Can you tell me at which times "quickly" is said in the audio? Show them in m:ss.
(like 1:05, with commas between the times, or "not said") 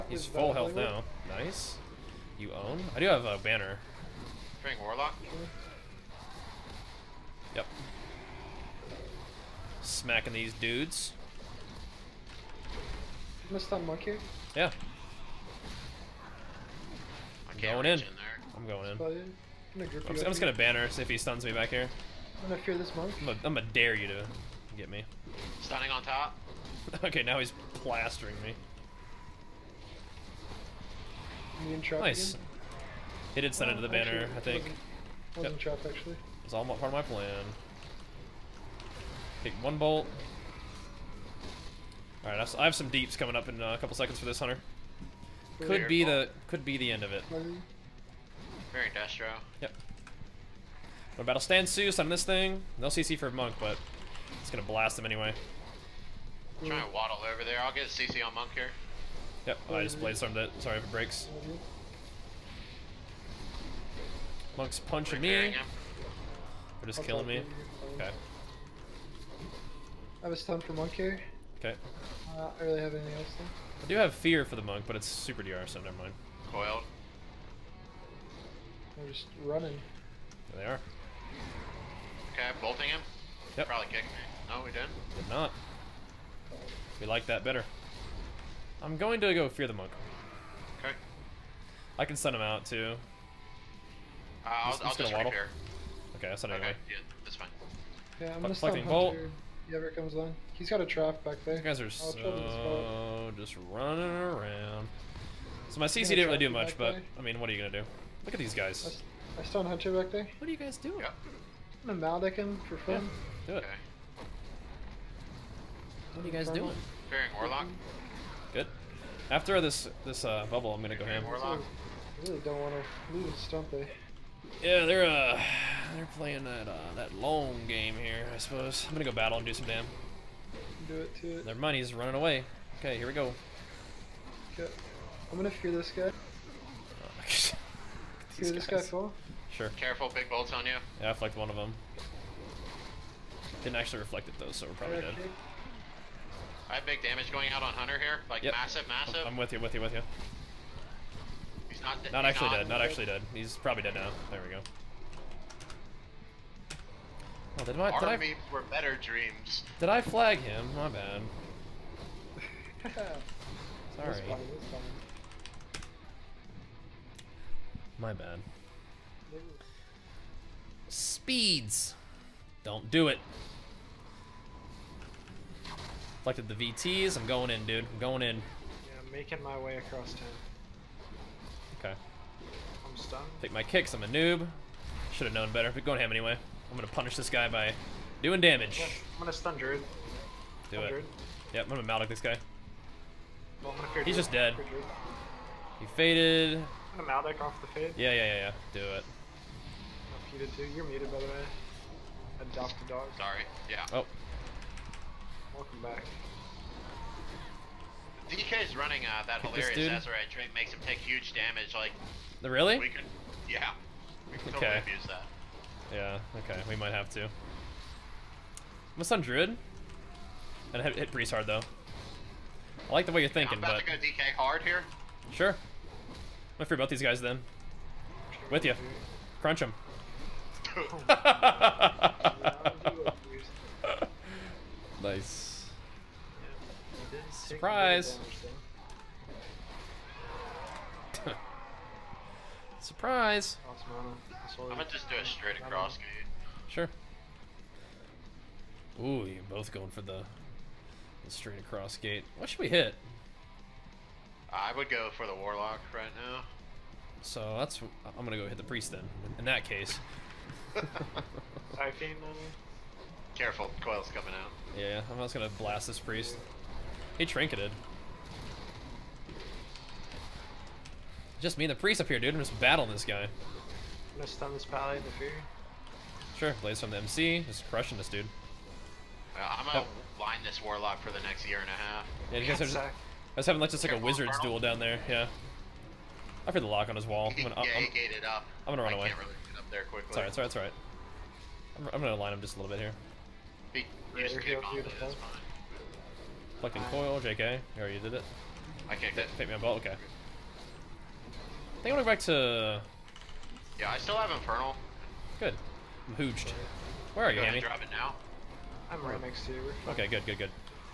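4:49.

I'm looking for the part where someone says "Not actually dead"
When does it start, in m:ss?
2:32.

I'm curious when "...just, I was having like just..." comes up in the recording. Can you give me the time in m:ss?
4:42.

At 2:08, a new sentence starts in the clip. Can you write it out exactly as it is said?
I suppose I'm gonna go battle and do some damn.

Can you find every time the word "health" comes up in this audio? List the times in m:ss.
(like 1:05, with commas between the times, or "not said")
0:00.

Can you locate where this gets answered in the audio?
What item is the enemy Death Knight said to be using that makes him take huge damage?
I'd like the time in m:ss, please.
3:29.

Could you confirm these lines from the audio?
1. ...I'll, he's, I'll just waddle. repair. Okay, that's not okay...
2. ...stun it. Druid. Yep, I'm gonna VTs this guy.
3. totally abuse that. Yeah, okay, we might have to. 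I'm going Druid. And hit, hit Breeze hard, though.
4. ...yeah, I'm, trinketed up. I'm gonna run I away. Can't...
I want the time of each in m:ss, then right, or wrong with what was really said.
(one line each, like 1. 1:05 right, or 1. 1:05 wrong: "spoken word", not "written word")
1. 1:34 right
2. 3:10 wrong: "Maldic", not "VTs"
3. 3:34 right
4. 4:47 wrong: "gated", not "trinketed".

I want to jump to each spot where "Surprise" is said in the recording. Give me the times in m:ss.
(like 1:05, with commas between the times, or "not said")
3:57, 4:02.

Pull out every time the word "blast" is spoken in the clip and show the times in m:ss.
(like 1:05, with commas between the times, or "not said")
0:54, 4:25.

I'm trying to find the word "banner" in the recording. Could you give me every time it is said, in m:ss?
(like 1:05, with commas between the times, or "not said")
0:03, 0:20, 0:33.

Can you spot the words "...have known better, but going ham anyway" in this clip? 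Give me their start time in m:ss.
3:05.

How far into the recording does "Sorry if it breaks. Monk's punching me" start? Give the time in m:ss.
1:00.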